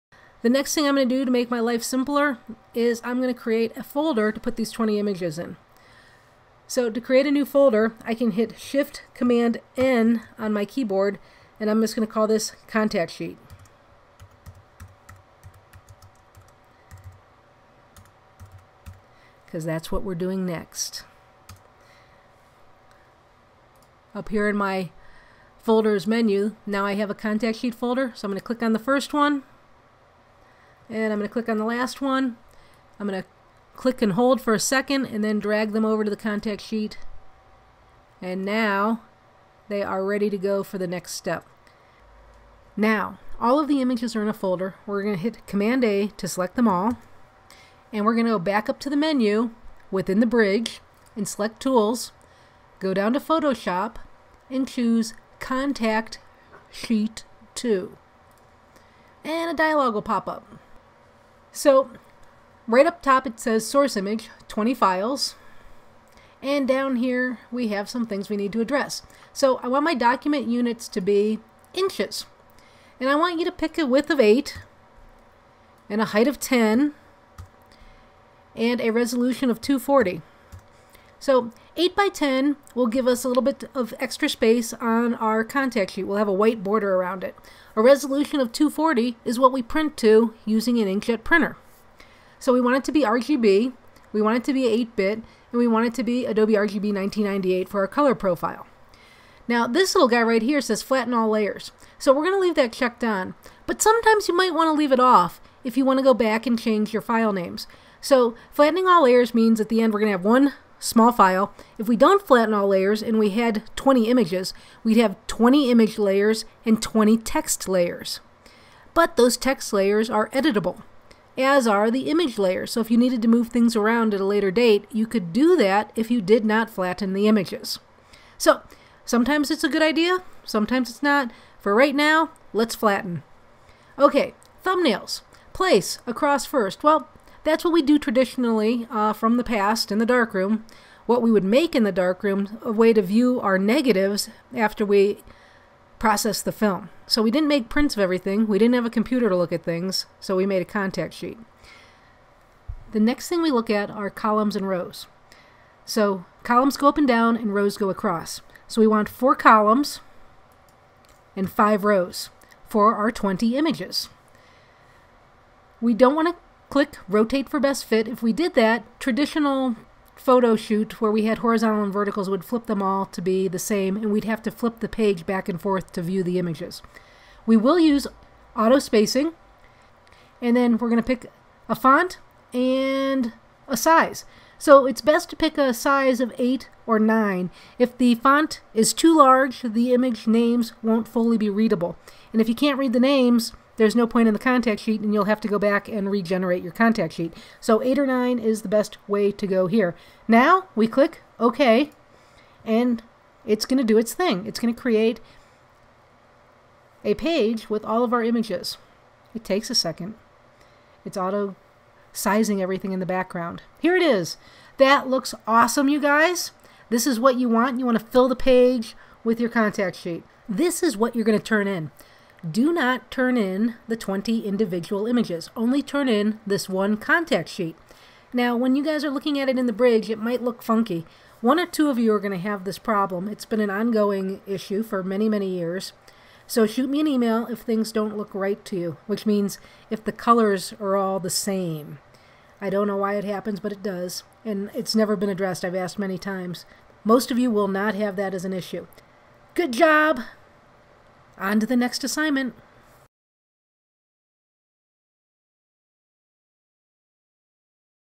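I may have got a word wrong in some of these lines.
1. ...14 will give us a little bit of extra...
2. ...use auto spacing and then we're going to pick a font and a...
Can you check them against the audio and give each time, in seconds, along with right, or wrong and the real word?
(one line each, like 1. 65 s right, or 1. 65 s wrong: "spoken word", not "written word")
1. 82 s wrong: "10", not "14"
2. 177 s right.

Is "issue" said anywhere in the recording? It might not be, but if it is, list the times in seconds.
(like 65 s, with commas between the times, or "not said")
234 s, 248 s.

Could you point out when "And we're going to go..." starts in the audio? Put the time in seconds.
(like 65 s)
47 s.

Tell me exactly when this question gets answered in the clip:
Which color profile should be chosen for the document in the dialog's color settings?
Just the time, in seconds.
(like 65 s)
96 s.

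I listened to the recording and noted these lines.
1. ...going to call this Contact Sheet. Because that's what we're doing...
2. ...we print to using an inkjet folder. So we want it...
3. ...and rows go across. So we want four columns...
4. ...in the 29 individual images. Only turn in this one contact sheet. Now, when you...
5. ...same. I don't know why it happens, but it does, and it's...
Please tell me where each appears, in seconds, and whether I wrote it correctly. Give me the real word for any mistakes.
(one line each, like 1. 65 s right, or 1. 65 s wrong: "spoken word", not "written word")
1. 11 s right
2. 89 s wrong: "printer", not "folder"
3. 157 s right
4. 223 s wrong: "20", not "29"
5. 241 s right.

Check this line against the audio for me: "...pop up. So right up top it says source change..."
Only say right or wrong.
wrong.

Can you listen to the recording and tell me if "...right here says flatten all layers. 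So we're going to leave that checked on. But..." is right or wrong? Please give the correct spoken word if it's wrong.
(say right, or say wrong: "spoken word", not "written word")
right.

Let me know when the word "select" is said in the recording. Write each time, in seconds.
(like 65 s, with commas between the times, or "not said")
46 s, 51 s.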